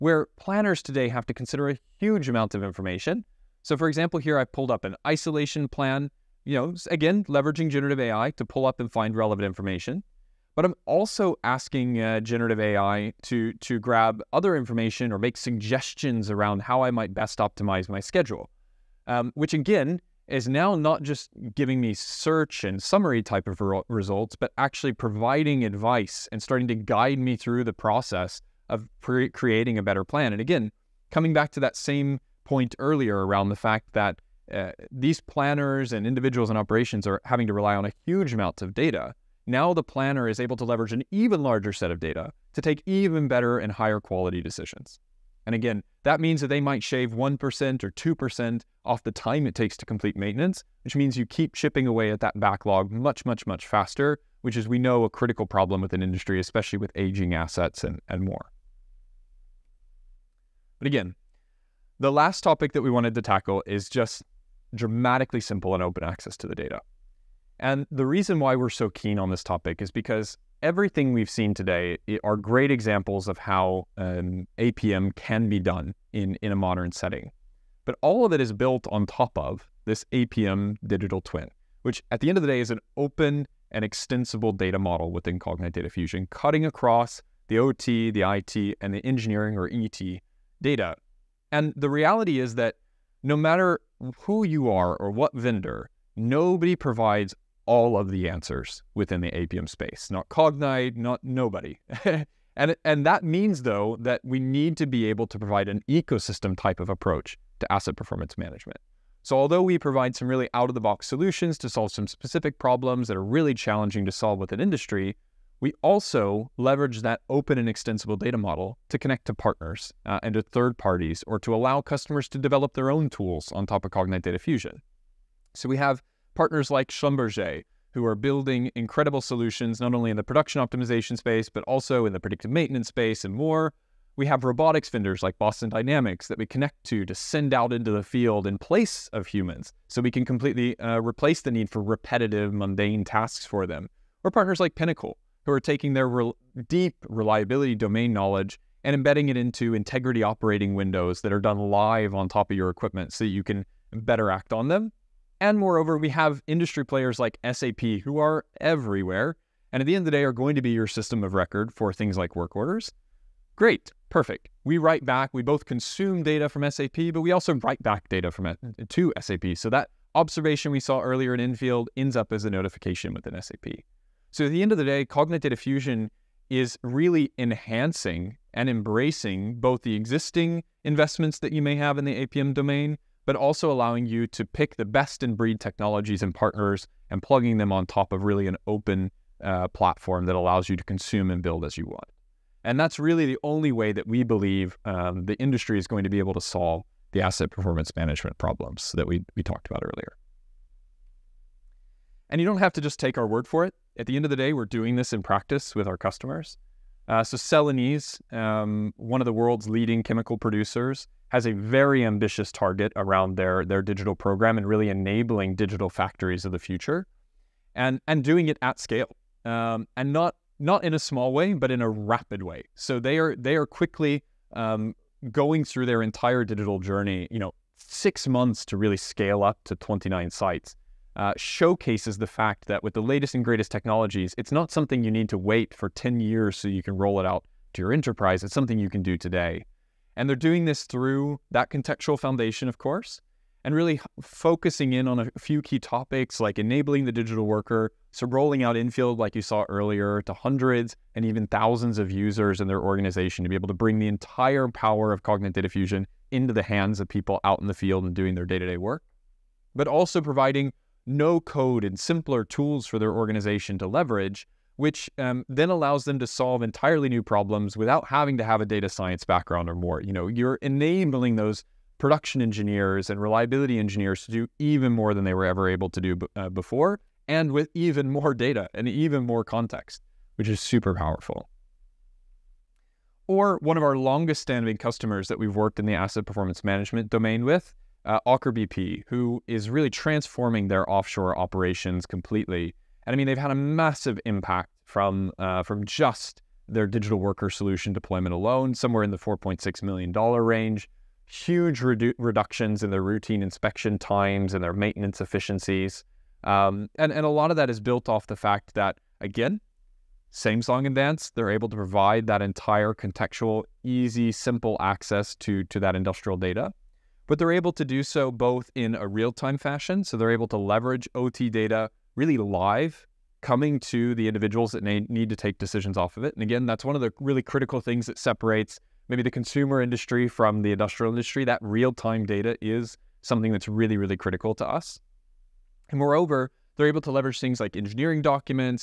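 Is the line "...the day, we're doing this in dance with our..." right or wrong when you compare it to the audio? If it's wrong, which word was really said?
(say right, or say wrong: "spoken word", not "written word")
wrong: "practice", not "dance".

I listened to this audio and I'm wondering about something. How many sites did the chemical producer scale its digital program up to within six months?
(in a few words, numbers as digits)
29.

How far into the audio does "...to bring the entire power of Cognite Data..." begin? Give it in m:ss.
4:13.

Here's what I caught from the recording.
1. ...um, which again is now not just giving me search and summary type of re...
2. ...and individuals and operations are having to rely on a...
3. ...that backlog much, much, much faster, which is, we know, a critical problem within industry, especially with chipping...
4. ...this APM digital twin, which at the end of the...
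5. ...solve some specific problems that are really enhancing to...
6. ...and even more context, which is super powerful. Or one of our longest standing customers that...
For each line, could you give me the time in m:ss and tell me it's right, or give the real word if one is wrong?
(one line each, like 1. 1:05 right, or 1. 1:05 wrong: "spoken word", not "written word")
1. 0:19 right
2. 0:35 right
3. 0:52 wrong: "aging", not "chipping"
4. 1:19 right
5. 1:51 wrong: "challenging", not "enhancing"
6. 4:38 right.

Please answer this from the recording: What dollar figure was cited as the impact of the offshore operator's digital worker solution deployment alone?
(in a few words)
$4.6 million.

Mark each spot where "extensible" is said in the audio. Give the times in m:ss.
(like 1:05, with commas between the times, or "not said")
1:23, 1:57.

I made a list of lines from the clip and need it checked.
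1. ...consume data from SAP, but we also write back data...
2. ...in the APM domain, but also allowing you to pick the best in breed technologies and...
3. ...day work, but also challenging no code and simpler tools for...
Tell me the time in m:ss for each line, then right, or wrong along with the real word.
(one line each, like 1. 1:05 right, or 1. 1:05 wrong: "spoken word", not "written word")
1. 2:45 right
2. 3:01 right
3. 4:18 wrong: "providing", not "challenging".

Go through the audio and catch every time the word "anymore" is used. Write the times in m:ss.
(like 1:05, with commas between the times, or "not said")
not said.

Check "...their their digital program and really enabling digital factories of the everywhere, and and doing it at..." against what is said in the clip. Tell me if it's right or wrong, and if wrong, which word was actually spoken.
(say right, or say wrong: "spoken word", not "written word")
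wrong: "future", not "everywhere".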